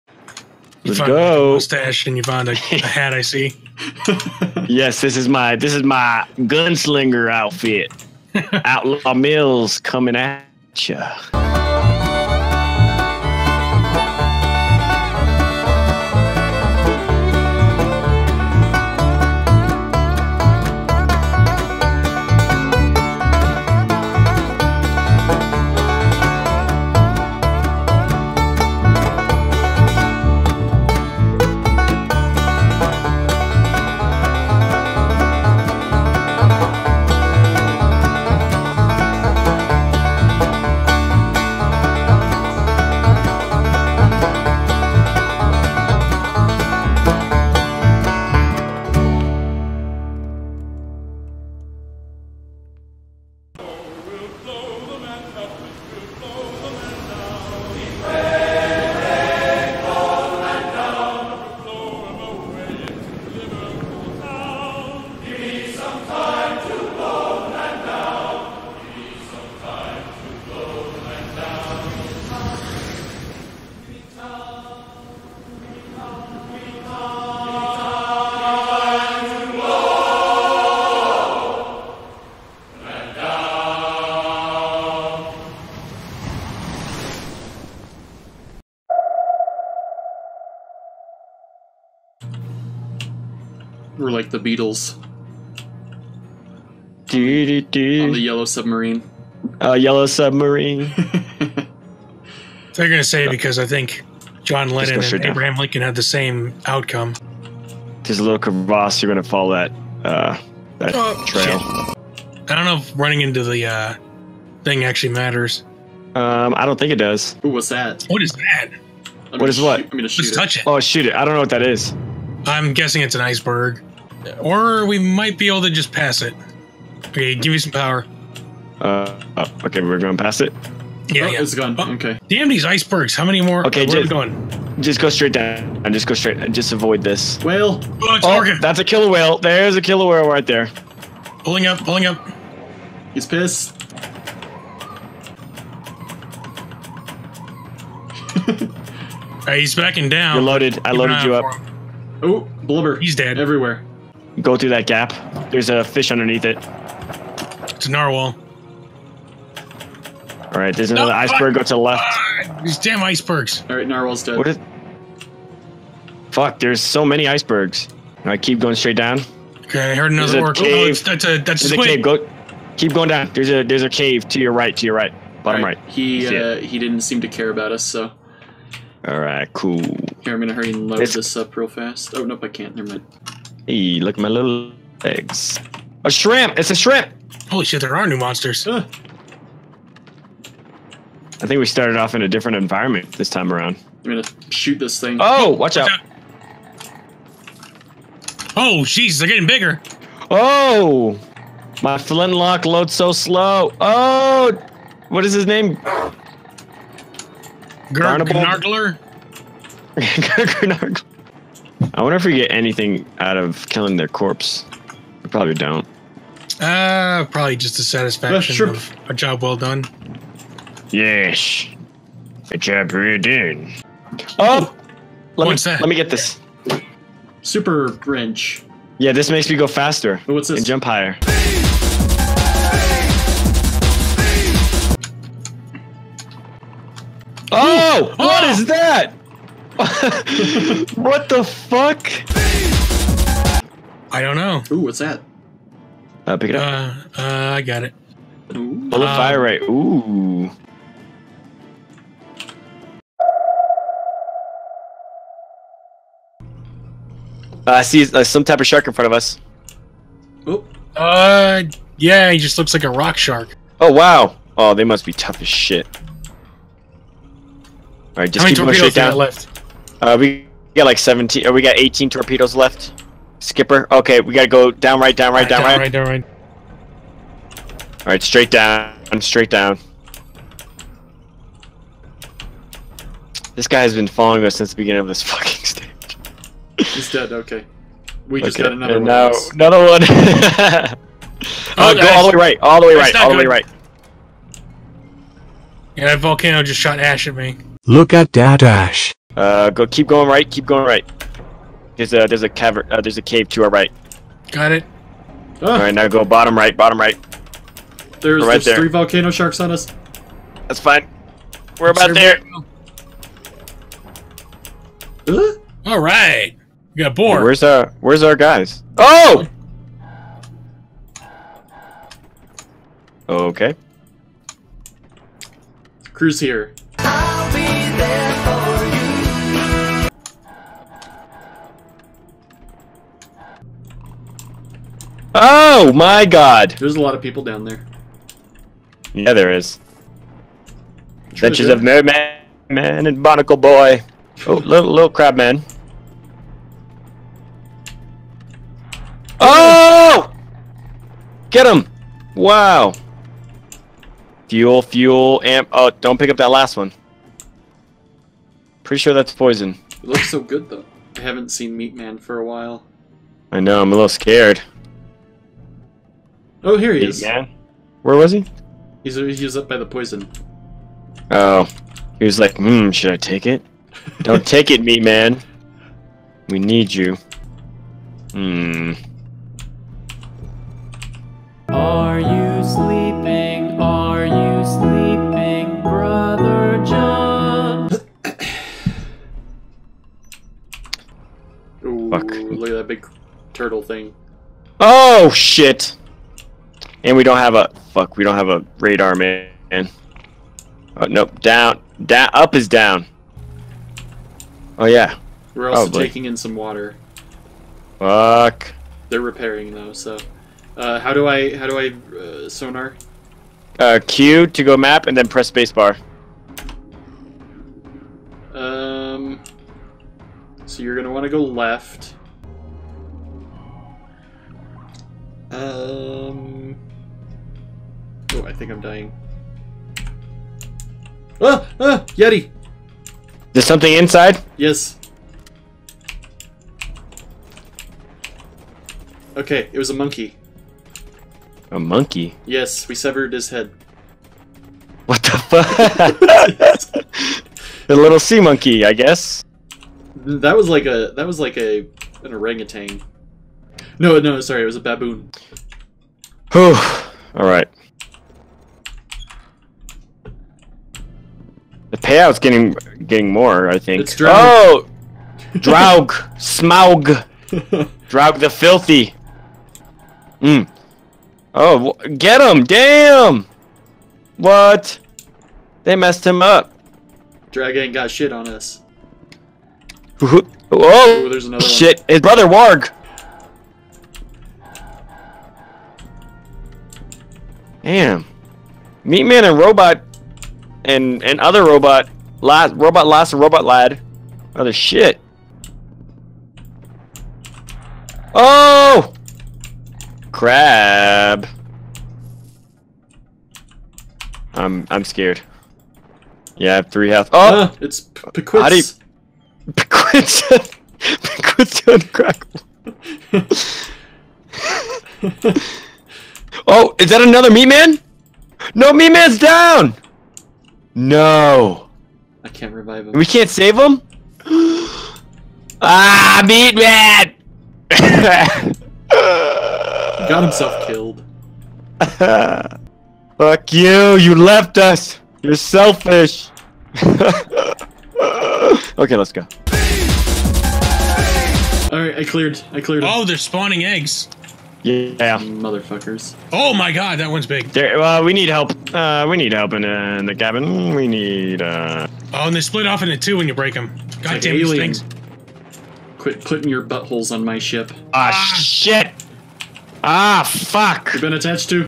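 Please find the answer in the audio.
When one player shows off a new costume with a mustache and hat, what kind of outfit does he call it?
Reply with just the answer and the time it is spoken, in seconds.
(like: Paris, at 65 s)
gunslinger outfit, at 6 s.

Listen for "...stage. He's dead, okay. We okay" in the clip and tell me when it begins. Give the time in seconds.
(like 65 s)
285 s.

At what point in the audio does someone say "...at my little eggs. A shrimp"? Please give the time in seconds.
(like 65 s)
184 s.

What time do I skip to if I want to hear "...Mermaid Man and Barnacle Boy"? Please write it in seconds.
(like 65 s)
341 s.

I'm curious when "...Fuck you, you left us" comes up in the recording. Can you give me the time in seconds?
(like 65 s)
533 s.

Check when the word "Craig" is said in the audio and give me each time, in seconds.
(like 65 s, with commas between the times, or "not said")
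not said.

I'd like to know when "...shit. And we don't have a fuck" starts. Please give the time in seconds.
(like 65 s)
395 s.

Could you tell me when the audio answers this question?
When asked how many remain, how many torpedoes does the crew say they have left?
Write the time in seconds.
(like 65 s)
271 s.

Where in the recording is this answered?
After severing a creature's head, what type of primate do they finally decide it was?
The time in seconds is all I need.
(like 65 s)
454 s.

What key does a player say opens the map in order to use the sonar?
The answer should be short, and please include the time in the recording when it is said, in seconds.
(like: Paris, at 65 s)
Q, at 414 s.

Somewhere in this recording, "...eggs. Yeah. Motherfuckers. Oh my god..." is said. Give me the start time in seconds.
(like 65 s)
543 s.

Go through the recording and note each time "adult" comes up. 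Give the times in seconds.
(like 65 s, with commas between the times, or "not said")
not said.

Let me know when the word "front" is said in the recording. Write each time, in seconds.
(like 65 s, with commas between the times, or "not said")
258 s.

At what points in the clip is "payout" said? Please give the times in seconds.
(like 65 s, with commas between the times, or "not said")
462 s.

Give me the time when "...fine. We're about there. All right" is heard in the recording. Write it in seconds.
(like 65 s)
310 s.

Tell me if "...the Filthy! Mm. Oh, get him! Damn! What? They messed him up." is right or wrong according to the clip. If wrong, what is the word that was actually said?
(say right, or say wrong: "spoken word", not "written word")
right.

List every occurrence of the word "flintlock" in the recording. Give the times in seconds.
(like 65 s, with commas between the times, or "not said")
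201 s.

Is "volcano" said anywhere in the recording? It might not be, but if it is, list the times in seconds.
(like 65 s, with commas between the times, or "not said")
296 s, 308 s.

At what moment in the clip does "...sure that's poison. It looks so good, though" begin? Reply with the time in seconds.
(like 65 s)
358 s.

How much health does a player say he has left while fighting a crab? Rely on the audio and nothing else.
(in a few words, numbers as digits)
3.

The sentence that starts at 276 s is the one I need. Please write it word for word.
Down right, All right, straight down, straight down.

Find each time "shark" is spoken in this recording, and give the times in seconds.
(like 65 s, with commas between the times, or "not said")
258 s, 263 s, 309 s.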